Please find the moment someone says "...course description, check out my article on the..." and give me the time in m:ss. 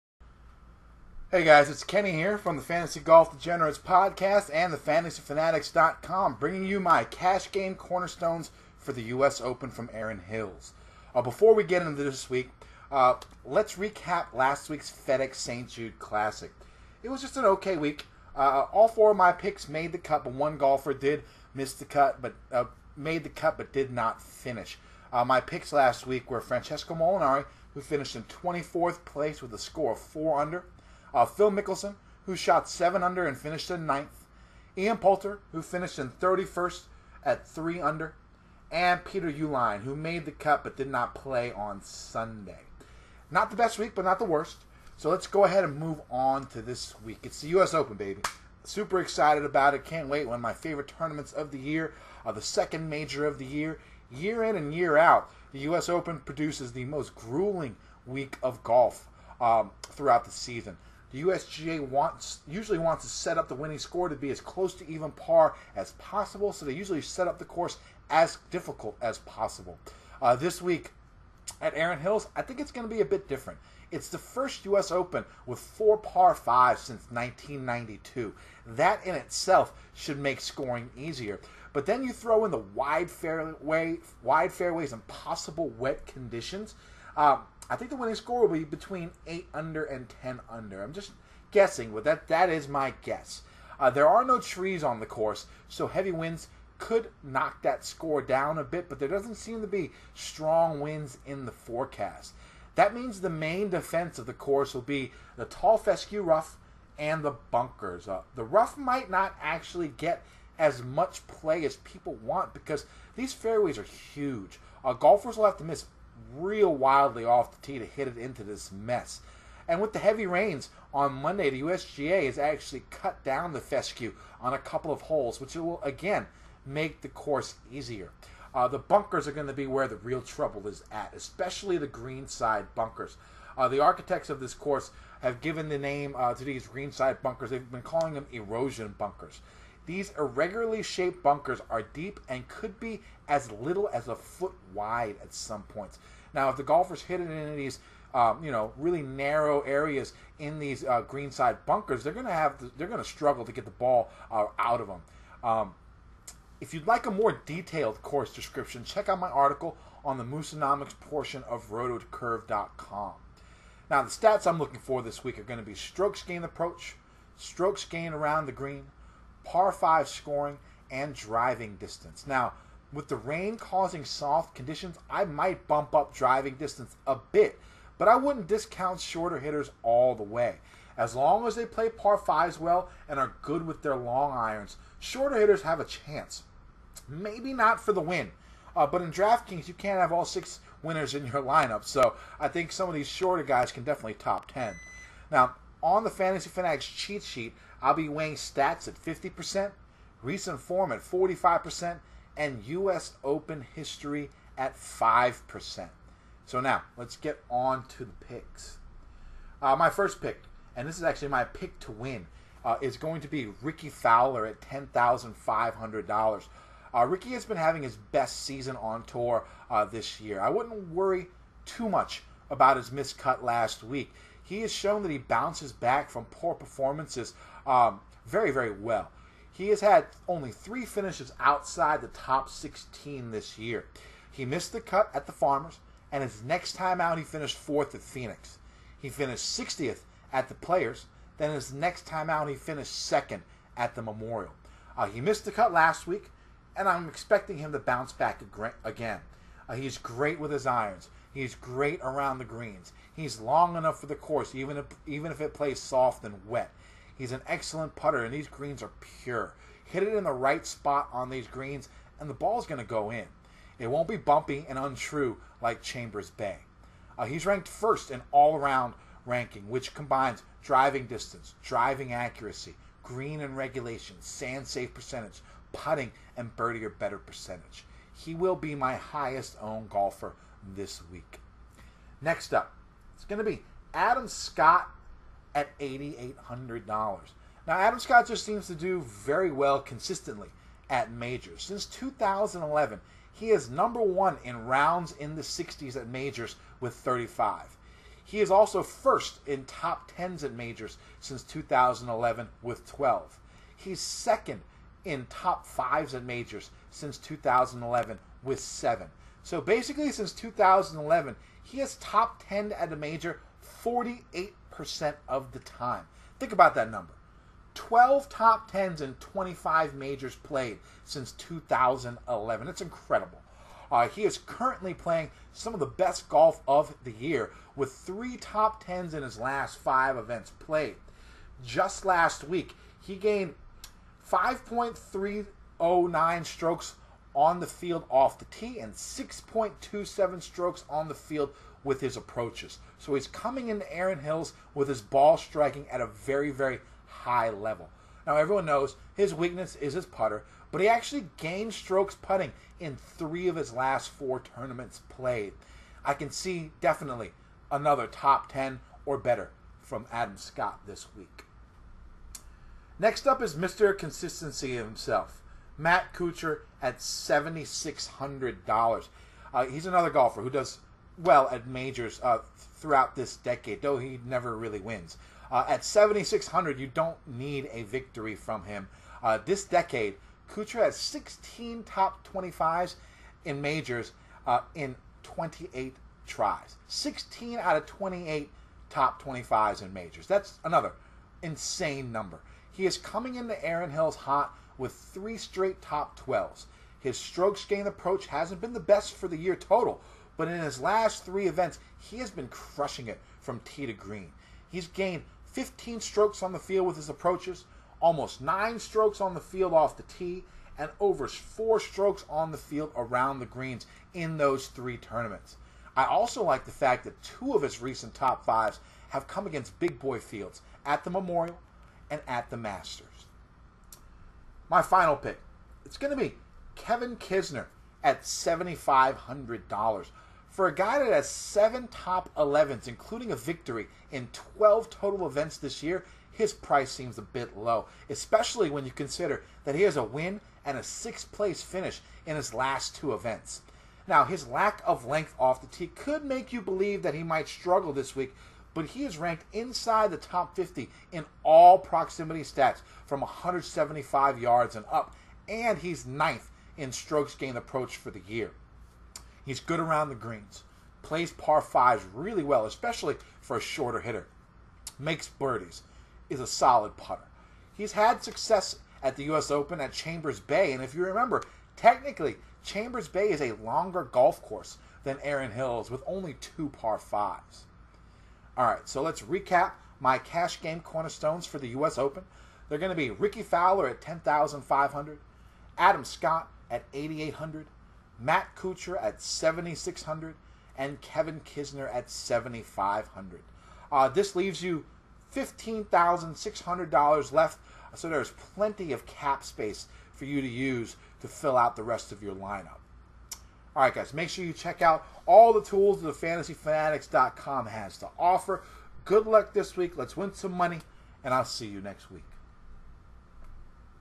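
2:38.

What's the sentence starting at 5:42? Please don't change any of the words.
So he's coming into Erin Hills with his ball striking at a very, very high level.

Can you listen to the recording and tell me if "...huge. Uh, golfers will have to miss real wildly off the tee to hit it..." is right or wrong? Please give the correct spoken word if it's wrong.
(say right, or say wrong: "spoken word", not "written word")
right.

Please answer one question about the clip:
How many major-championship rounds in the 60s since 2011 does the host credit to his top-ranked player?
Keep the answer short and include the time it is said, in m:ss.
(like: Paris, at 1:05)
35, at 4:56.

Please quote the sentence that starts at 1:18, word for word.
That in itself should make scoring easier.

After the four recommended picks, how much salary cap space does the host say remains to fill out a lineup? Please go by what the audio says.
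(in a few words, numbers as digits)
$15,600.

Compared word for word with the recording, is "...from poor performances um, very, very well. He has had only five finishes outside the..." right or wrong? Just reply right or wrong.
wrong.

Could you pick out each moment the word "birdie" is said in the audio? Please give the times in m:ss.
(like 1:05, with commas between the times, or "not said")
4:36, 7:45.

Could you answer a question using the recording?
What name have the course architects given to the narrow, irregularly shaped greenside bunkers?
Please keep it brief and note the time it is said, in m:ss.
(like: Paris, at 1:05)
Erosion bunkers, at 2:18.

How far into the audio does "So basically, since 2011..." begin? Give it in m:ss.
5:09.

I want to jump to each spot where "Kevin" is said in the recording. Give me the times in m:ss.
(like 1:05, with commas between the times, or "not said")
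7:06, 8:11.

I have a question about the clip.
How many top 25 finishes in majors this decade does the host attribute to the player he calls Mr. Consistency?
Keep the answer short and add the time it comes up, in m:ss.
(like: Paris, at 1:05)
16, at 6:20.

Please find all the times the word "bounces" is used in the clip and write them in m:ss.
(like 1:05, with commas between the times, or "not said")
3:45, 4:07.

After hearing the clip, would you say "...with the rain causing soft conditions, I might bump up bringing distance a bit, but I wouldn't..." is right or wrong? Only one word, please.
wrong.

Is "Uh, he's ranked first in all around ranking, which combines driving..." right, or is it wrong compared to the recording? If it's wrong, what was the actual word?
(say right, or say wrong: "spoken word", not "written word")
right.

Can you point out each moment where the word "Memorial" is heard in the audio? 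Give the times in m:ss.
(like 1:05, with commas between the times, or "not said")
4:04, 7:01.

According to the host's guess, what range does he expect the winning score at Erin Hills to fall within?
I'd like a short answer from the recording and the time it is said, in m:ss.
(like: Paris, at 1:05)
8 under to 10 under, at 1:28.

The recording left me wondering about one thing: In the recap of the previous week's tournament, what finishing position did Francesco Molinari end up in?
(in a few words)
24th.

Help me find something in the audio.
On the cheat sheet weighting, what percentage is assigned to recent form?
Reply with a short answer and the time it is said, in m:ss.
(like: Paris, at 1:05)
45%, at 3:20.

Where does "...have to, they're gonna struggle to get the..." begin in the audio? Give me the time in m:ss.
2:32.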